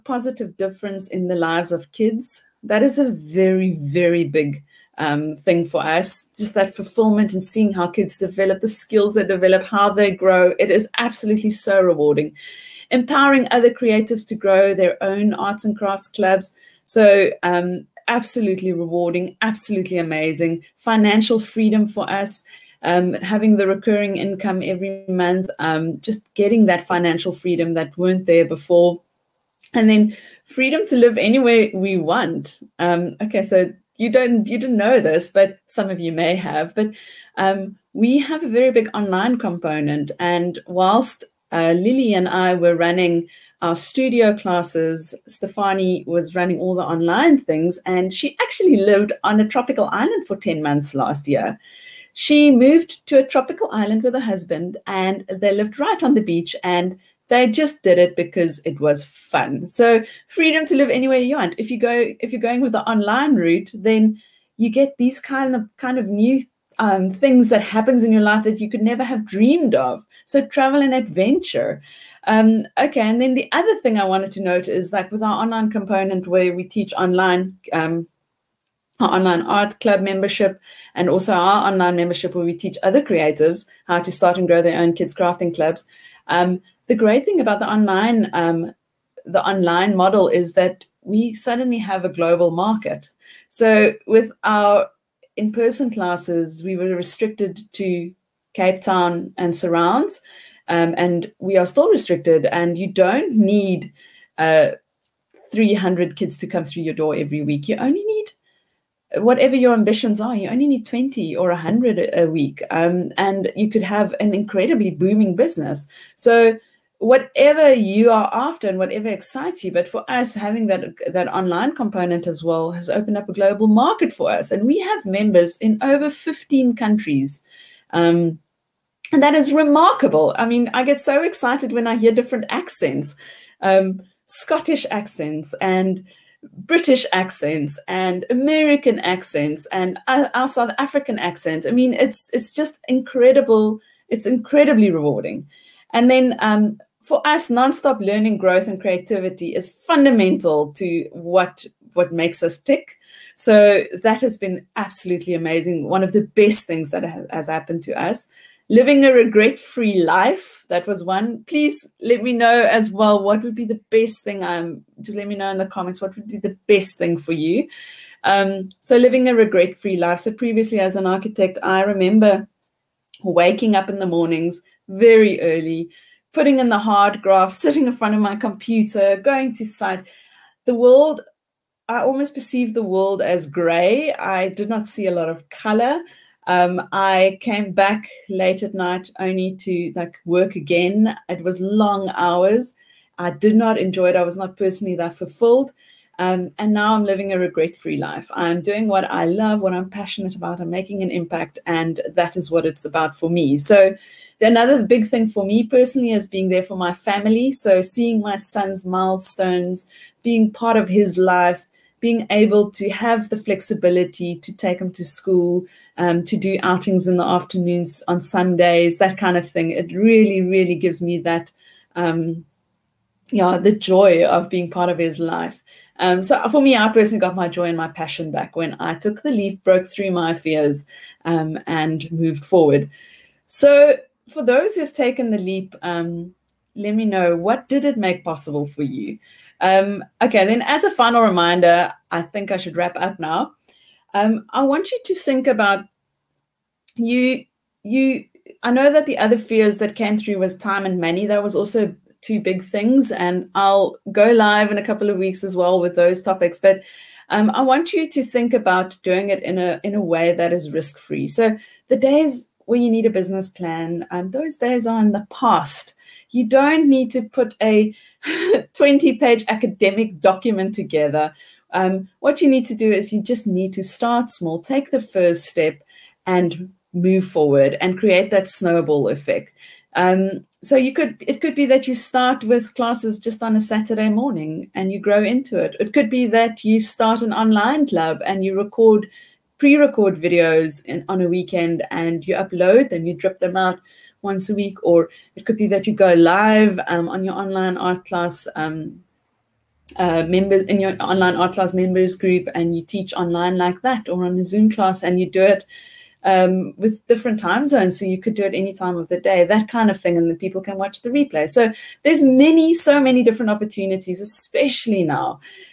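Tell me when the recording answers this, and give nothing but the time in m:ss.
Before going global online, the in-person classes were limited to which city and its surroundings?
1:38.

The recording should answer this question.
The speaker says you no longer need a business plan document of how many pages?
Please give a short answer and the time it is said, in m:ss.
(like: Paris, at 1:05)
20, at 4:28.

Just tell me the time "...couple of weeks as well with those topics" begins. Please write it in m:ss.
4:14.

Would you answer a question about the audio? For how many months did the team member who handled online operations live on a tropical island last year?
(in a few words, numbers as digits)
10.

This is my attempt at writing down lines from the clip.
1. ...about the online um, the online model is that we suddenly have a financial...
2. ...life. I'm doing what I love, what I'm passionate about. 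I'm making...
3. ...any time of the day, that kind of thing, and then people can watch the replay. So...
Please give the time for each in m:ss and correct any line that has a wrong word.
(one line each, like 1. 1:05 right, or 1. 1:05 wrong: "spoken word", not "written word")
1. 1:27 wrong: "global", not "financial"
2. 3:17 right
3. 5:08 right.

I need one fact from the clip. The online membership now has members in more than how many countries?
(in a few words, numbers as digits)
15.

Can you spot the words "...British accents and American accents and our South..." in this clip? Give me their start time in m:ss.
2:16.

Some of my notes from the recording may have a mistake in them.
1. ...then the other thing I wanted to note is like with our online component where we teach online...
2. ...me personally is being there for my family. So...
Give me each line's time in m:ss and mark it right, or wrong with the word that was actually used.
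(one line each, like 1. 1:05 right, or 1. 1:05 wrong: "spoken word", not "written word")
1. 1:13 right
2. 3:25 right.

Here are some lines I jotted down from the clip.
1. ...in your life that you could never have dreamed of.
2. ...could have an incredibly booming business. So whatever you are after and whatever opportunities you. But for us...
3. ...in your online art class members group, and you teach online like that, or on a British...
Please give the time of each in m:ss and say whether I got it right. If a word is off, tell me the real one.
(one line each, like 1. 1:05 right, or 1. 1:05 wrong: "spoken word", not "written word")
1. 1:08 right
2. 1:53 wrong: "excites", not "opportunities"
3. 5:00 wrong: "Zoom", not "British".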